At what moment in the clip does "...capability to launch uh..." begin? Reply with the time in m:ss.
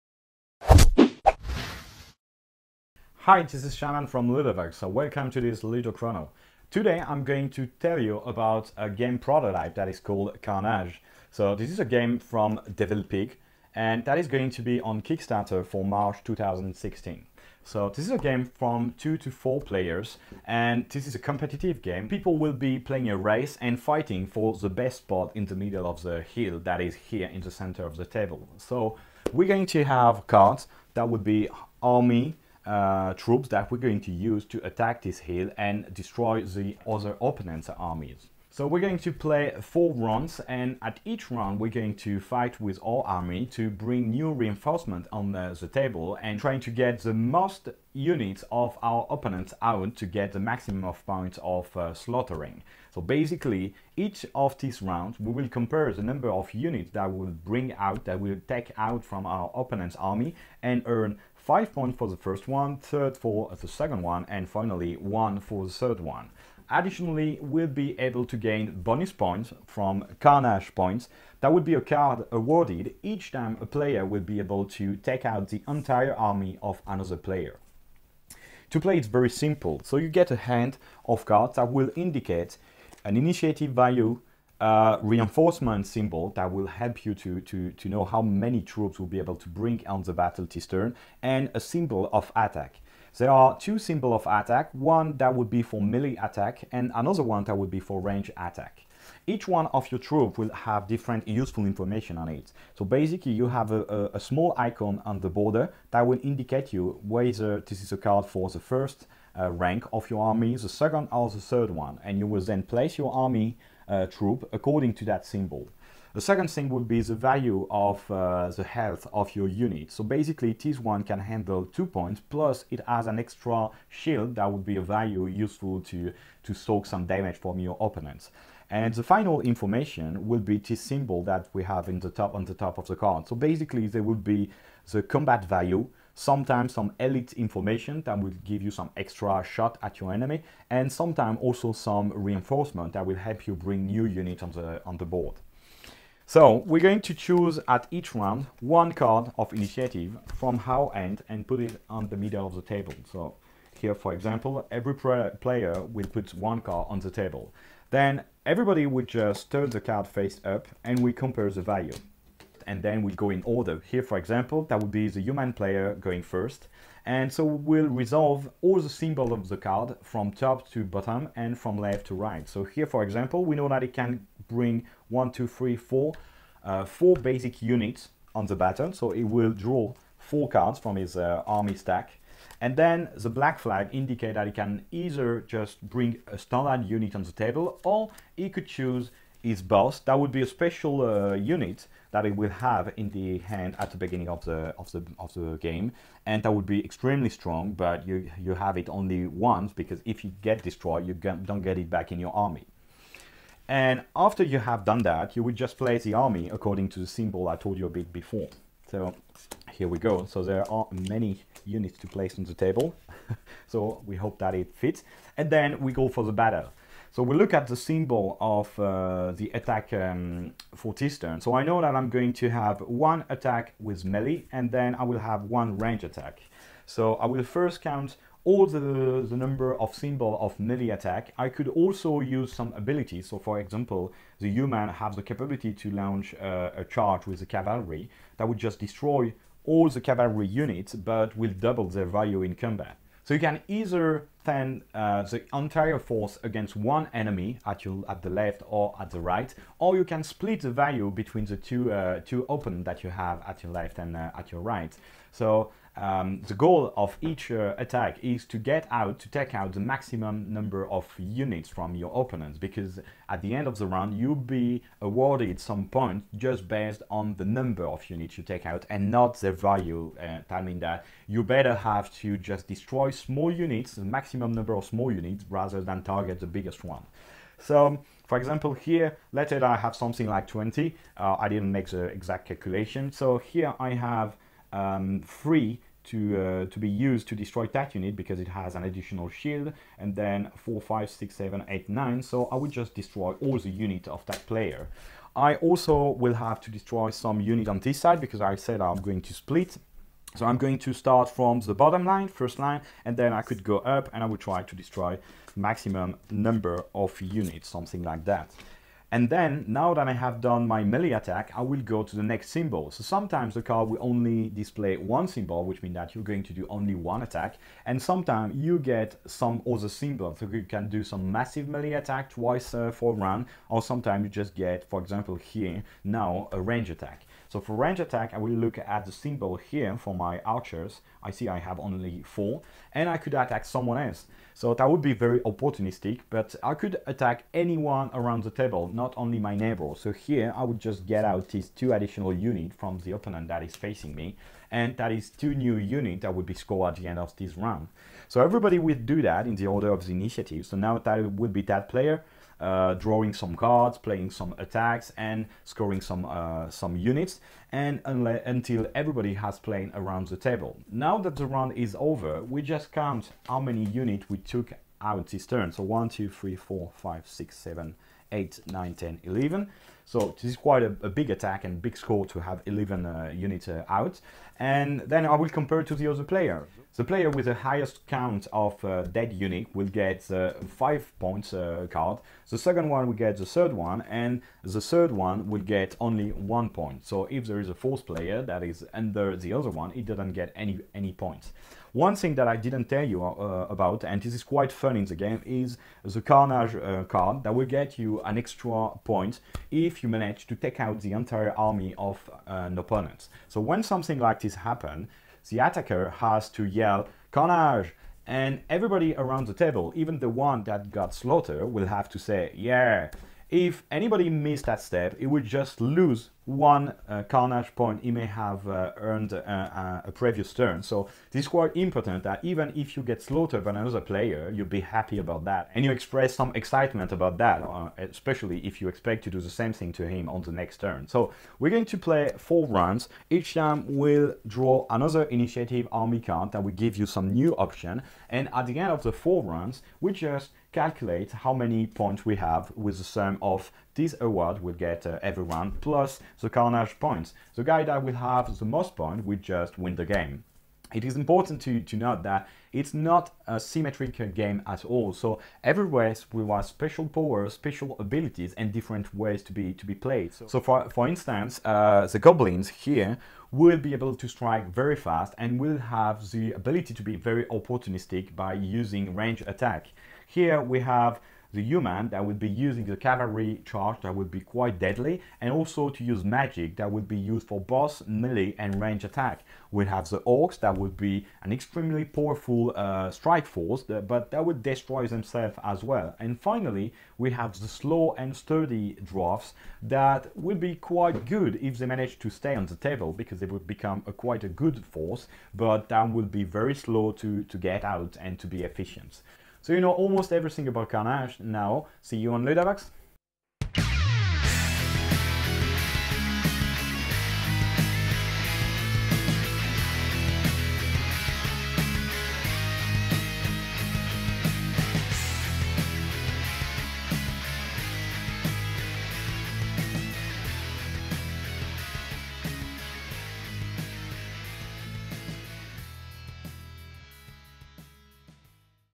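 3:55.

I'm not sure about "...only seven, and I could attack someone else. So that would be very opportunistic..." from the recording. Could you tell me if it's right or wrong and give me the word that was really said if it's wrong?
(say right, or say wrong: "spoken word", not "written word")
wrong: "four", not "seven".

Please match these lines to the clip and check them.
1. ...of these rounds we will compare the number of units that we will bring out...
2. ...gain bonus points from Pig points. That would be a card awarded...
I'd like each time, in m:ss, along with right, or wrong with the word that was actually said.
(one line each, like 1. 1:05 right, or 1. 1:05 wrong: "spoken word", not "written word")
1. 0:54 right
2. 1:08 wrong: "Carnage", not "Pig".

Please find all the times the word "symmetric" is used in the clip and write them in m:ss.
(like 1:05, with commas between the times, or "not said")
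7:33.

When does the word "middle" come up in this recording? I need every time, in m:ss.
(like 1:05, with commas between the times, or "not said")
0:25, 2:32.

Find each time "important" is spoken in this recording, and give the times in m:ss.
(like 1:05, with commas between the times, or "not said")
7:01, 7:31.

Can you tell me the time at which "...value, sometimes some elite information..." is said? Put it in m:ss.
2:15.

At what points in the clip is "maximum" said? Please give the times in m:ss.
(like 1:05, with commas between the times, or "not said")
0:50, 4:19, 4:34, 5:05.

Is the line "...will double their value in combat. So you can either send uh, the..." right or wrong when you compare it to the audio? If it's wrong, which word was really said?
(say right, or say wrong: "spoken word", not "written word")
right.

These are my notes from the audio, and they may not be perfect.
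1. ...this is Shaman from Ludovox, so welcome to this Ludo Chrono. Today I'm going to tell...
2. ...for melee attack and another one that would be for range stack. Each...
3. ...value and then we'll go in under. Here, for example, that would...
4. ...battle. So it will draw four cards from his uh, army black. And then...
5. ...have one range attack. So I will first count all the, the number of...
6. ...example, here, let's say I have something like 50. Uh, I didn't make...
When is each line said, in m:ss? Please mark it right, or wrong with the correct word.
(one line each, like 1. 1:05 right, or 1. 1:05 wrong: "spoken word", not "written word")
1. 0:03 right
2. 1:35 wrong: "attack", not "stack"
3. 2:41 wrong: "order", not "under"
4. 2:58 wrong: "stack", not "black"
5. 3:45 right
6. 4:38 wrong: "20", not "50".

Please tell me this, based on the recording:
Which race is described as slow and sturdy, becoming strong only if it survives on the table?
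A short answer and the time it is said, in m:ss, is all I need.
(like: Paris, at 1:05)
dwarfs, at 8:09.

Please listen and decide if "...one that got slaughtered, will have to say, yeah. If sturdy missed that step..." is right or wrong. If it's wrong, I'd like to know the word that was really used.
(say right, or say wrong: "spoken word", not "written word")
wrong: "anybody", not "sturdy".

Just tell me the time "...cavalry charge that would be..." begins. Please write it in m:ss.
7:52.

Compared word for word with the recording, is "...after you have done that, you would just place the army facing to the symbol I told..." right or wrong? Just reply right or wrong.
wrong.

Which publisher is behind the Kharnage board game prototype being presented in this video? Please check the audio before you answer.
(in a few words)
Devil Pig.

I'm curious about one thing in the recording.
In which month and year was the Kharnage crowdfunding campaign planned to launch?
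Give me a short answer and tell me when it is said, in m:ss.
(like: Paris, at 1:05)
March 2016, at 0:15.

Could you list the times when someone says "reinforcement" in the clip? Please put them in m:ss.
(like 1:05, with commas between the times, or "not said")
0:44, 1:25, 2:22.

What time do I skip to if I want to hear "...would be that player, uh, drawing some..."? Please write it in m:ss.
5:51.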